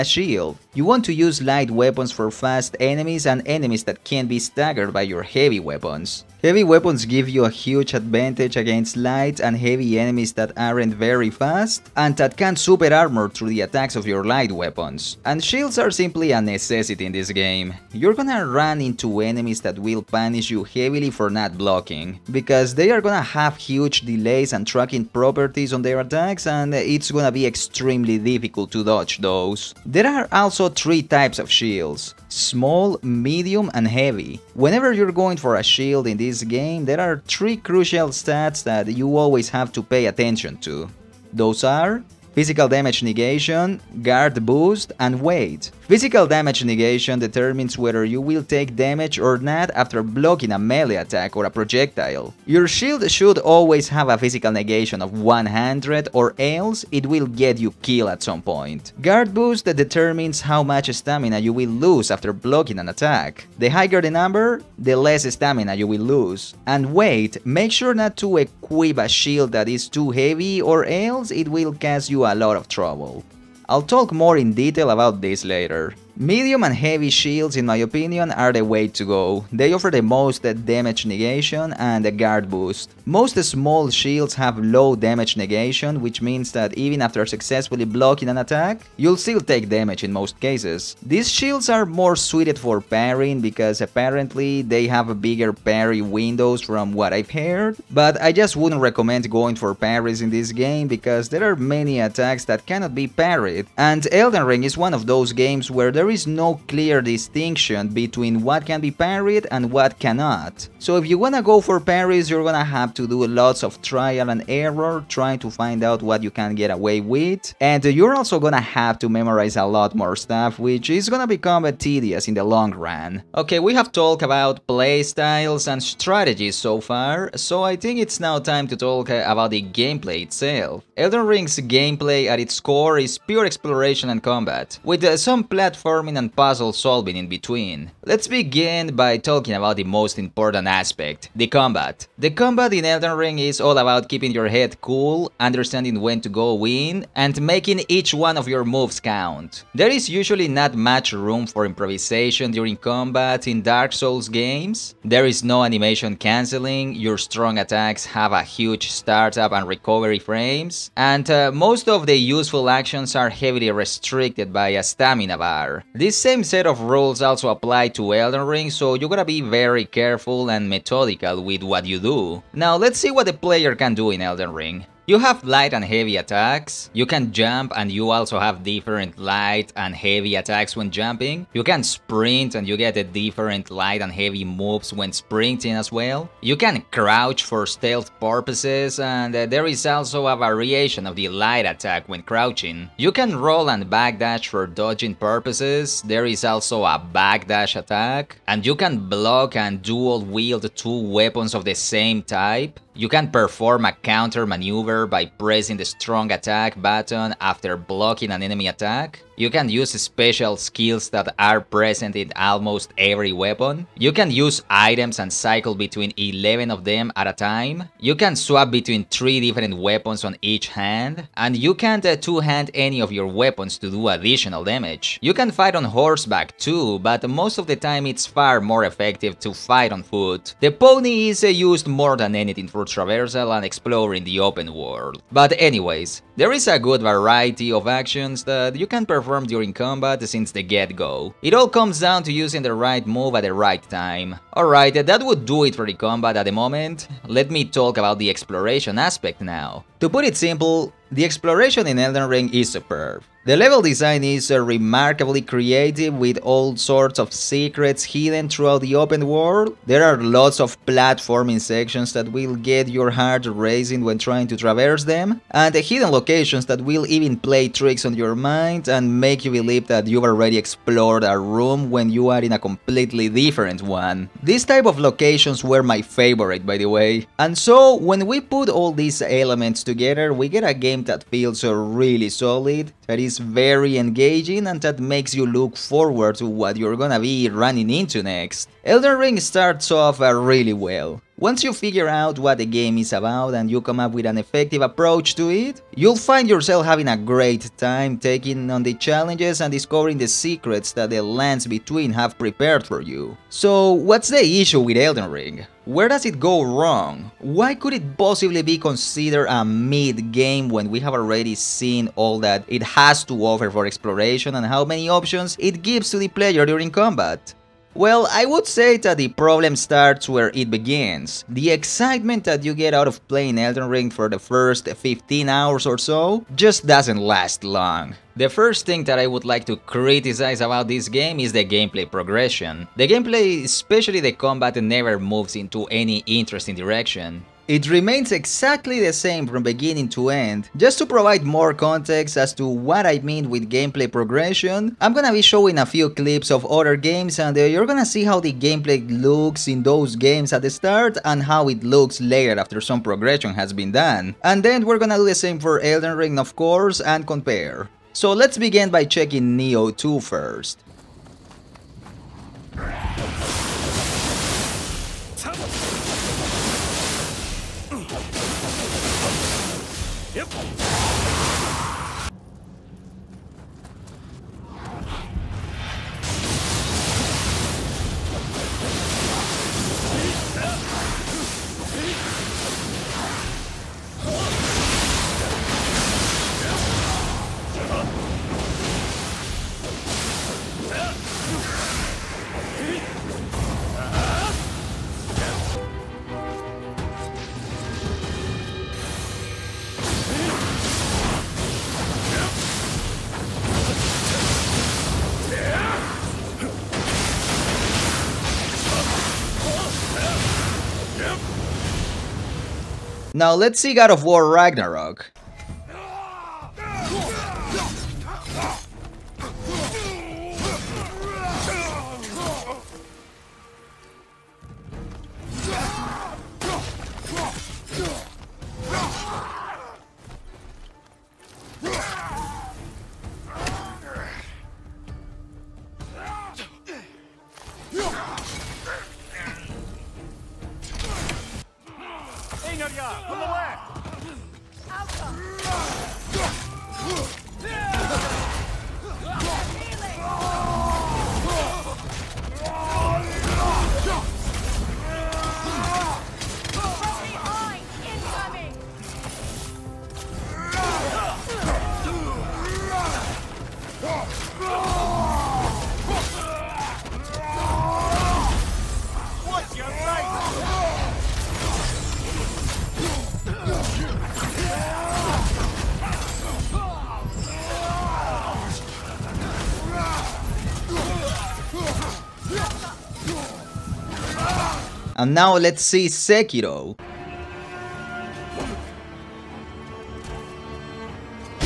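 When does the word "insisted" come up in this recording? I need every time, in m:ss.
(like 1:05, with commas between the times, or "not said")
not said.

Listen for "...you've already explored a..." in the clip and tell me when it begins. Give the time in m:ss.
4:30.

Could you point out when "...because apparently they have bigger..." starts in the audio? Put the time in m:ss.
1:33.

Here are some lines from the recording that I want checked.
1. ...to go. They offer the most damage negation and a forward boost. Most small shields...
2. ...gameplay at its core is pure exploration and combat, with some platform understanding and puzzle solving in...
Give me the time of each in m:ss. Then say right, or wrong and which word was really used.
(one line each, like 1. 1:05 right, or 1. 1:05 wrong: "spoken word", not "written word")
1. 1:18 wrong: "guard", not "forward"
2. 2:11 wrong: "platforming", not "understanding".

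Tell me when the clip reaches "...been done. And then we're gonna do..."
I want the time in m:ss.
5:53.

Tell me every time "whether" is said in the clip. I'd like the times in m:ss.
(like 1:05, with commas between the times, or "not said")
0:47.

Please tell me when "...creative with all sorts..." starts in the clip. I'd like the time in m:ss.
4:15.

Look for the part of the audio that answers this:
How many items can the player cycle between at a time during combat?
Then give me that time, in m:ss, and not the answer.
3:36.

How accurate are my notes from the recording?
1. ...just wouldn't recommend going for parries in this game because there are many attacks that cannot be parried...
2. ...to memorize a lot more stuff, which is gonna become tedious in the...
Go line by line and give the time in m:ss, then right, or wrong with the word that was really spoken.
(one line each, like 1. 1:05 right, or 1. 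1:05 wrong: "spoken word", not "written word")
1. 1:38 right
2. 1:58 right.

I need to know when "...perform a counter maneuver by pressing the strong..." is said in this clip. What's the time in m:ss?
3:23.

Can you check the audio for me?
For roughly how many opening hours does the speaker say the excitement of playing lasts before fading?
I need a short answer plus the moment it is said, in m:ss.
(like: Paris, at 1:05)
15 hours, at 5:24.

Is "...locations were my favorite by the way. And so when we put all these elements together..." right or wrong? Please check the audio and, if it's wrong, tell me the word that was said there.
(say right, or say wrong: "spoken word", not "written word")
right.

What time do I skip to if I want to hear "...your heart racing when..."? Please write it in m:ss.
4:22.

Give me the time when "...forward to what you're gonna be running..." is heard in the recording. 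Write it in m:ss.
4:45.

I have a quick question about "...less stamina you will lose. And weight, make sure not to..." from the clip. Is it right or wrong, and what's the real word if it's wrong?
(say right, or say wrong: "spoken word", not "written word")
right.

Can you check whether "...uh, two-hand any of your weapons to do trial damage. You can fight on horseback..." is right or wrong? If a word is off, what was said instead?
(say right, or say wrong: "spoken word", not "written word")
wrong: "additional", not "trial".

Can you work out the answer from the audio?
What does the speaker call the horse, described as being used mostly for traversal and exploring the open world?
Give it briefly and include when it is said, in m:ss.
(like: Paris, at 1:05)
The pony, at 3:50.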